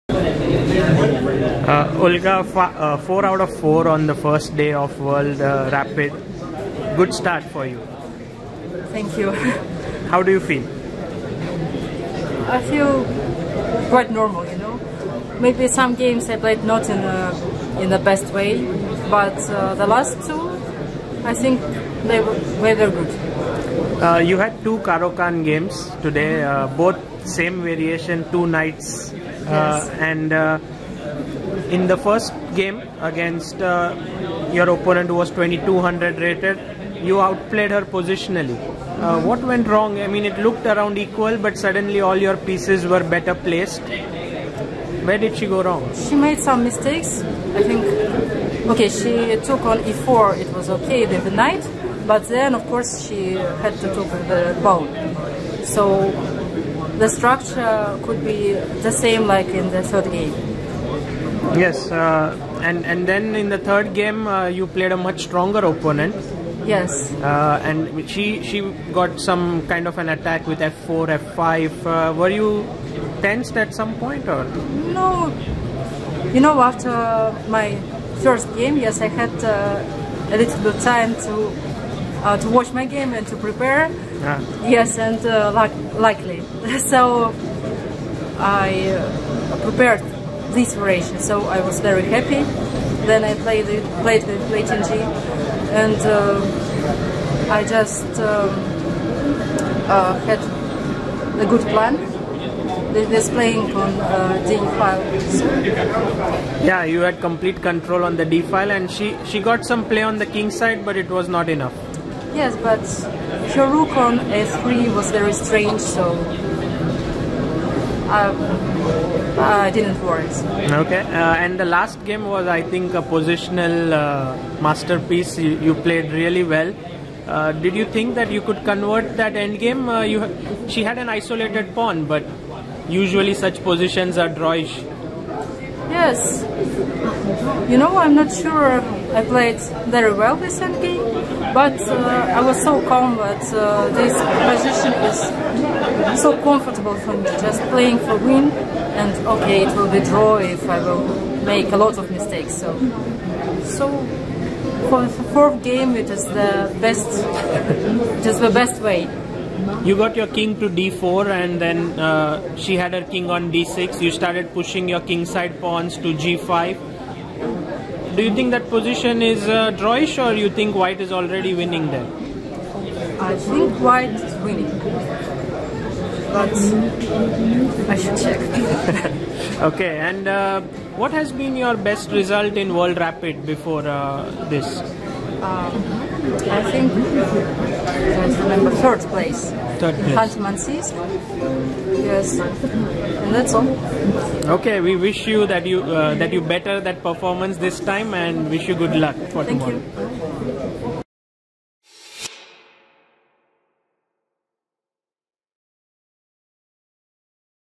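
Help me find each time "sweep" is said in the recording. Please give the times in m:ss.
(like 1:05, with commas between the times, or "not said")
not said.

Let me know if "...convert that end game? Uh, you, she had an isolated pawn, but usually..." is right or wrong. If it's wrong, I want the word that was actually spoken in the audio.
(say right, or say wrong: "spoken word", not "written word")
right.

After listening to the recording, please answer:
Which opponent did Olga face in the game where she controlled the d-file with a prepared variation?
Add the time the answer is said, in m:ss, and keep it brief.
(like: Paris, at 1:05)
Lei Tingjie, at 1:34.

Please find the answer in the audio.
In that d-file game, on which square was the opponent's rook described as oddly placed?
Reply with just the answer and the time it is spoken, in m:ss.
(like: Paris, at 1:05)
a3, at 1:54.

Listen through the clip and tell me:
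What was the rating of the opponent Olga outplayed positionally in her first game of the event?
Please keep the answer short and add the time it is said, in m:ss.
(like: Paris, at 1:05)
2200, at 0:35.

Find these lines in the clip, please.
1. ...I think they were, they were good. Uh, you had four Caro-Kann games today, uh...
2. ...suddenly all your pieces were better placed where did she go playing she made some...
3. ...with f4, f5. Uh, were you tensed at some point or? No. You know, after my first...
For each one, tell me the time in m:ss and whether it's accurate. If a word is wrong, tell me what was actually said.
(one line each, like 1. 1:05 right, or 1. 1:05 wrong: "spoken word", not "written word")
1. 0:21 wrong: "two", not "four"
2. 0:41 wrong: "wrong", not "playing"
3. 1:10 right.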